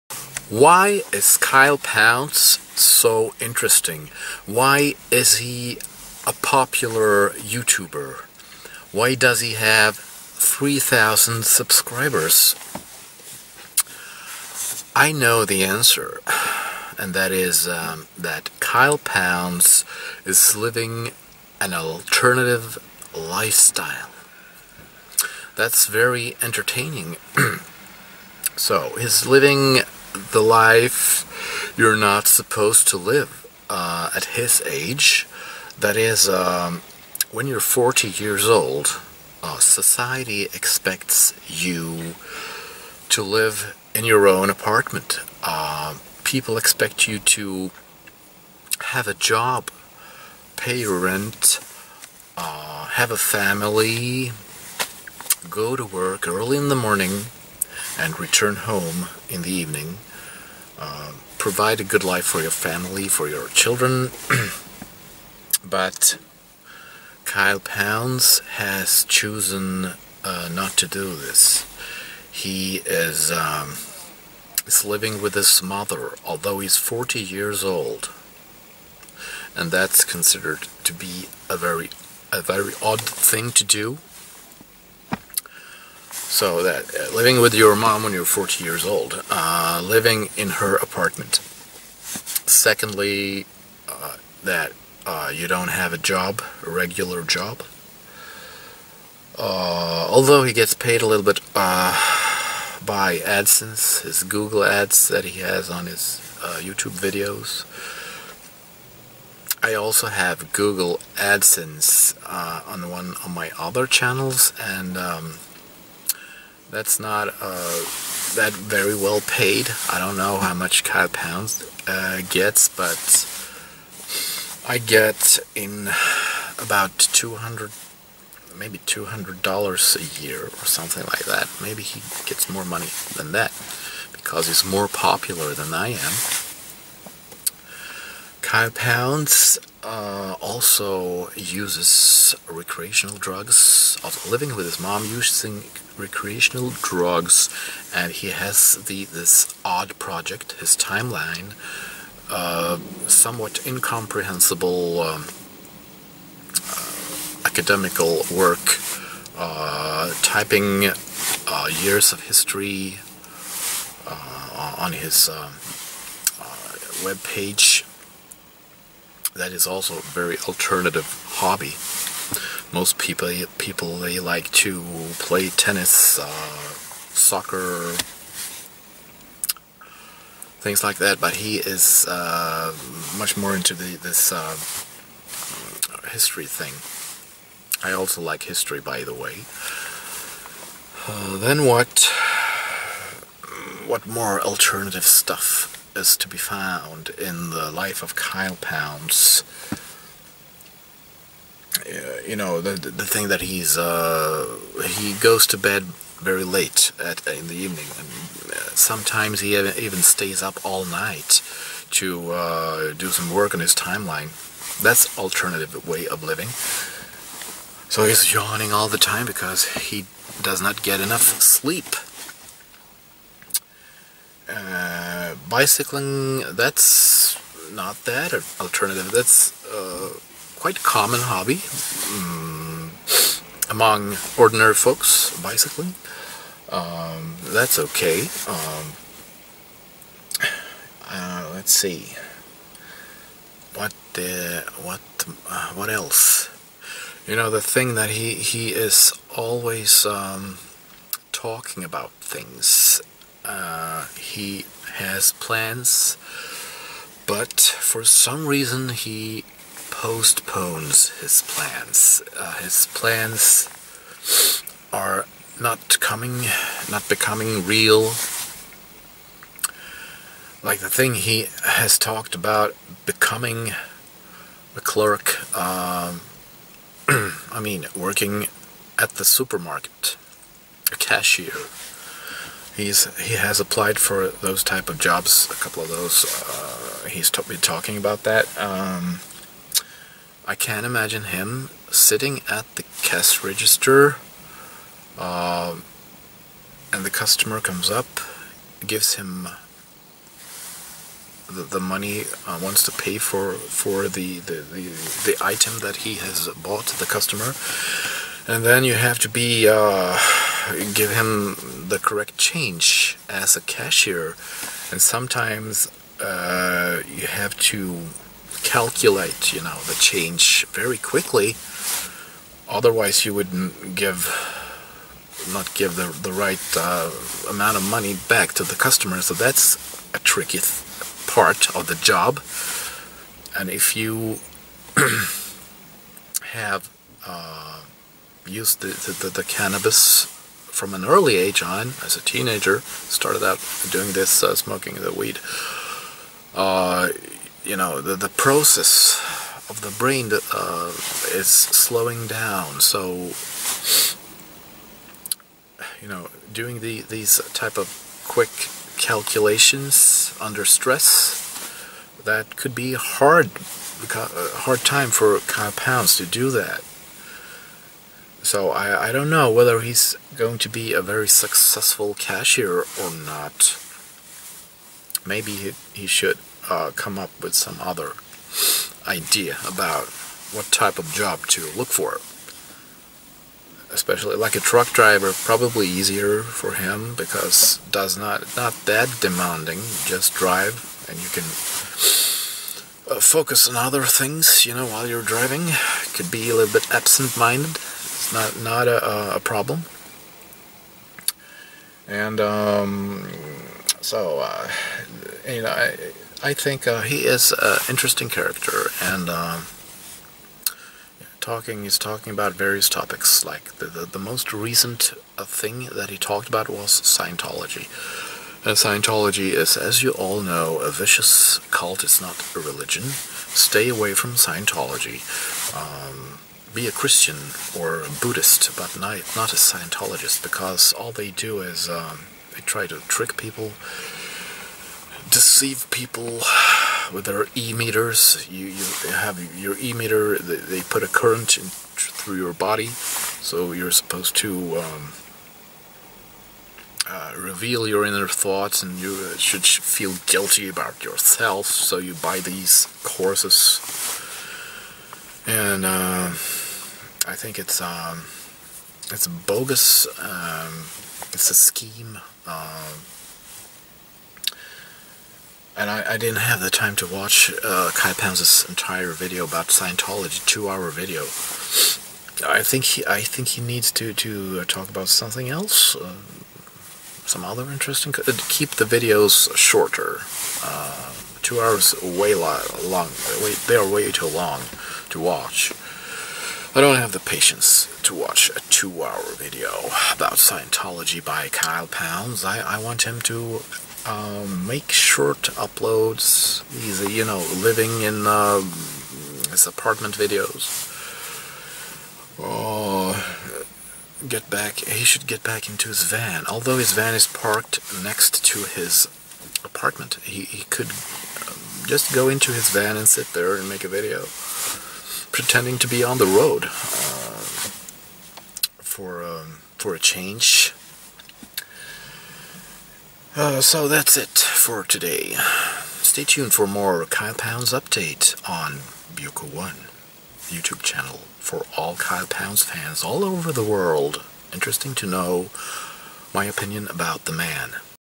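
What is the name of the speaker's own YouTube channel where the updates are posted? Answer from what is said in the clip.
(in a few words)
Buiko One.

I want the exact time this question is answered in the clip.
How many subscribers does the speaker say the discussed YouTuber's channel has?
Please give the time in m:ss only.
0:09.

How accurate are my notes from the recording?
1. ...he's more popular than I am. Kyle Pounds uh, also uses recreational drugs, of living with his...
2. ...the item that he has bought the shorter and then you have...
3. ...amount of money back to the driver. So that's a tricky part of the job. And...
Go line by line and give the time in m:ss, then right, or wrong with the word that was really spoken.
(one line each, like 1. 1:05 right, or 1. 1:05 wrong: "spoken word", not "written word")
1. 2:14 right
2. 5:05 wrong: "customer", not "shorter"
3. 5:27 wrong: "customer", not "driver".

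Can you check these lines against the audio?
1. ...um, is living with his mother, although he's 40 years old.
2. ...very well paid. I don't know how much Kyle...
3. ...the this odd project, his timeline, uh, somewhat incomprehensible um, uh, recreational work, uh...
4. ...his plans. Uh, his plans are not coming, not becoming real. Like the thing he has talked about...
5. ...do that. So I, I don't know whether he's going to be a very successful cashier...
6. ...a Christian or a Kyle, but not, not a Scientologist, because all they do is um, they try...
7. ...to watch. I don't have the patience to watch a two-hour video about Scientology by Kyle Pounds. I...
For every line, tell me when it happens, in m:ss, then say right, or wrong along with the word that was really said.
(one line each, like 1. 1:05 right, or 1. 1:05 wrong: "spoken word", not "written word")
1. 1:13 right
2. 1:58 right
3. 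2:28 wrong: "academical", not "recreational"
4. 4:21 right
5. 6:06 right
6. 7:06 wrong: "Buddhist", not "Kyle"
7. 8:05 right.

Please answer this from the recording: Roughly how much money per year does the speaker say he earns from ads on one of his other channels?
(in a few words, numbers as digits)
$200.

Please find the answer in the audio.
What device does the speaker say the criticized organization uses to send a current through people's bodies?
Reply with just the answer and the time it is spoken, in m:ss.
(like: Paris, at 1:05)
e-meter, at 7:17.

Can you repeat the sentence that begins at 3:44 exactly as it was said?
Uh, bicycling, that's not that alternative.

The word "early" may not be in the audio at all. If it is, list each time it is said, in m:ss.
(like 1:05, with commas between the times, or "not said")
0:56, 5:41.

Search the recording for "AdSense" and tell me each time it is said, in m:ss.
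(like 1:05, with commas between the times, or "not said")
1:43, 1:51.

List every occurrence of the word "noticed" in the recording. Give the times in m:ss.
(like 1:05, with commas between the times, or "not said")
not said.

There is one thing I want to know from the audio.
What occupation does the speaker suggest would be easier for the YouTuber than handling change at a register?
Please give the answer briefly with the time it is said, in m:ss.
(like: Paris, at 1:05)
truck driver, at 6:24.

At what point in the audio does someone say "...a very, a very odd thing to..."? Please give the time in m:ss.
1:21.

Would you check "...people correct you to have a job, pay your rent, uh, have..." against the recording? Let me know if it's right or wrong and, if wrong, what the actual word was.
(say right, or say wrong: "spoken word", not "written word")
wrong: "expect", not "correct".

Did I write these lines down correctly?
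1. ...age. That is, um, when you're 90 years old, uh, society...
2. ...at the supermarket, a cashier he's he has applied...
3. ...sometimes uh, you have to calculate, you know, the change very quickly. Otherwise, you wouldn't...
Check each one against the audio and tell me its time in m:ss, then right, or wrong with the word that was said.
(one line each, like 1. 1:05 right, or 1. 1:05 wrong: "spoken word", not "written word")
1. 0:34 wrong: "40", not "90"
2. 4:38 right
3. 5:15 right.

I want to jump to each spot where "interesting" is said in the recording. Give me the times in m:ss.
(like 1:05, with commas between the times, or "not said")
0:03, 6:47, 7:57, 8:54.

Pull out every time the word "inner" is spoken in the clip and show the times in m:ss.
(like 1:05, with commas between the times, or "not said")
7:28.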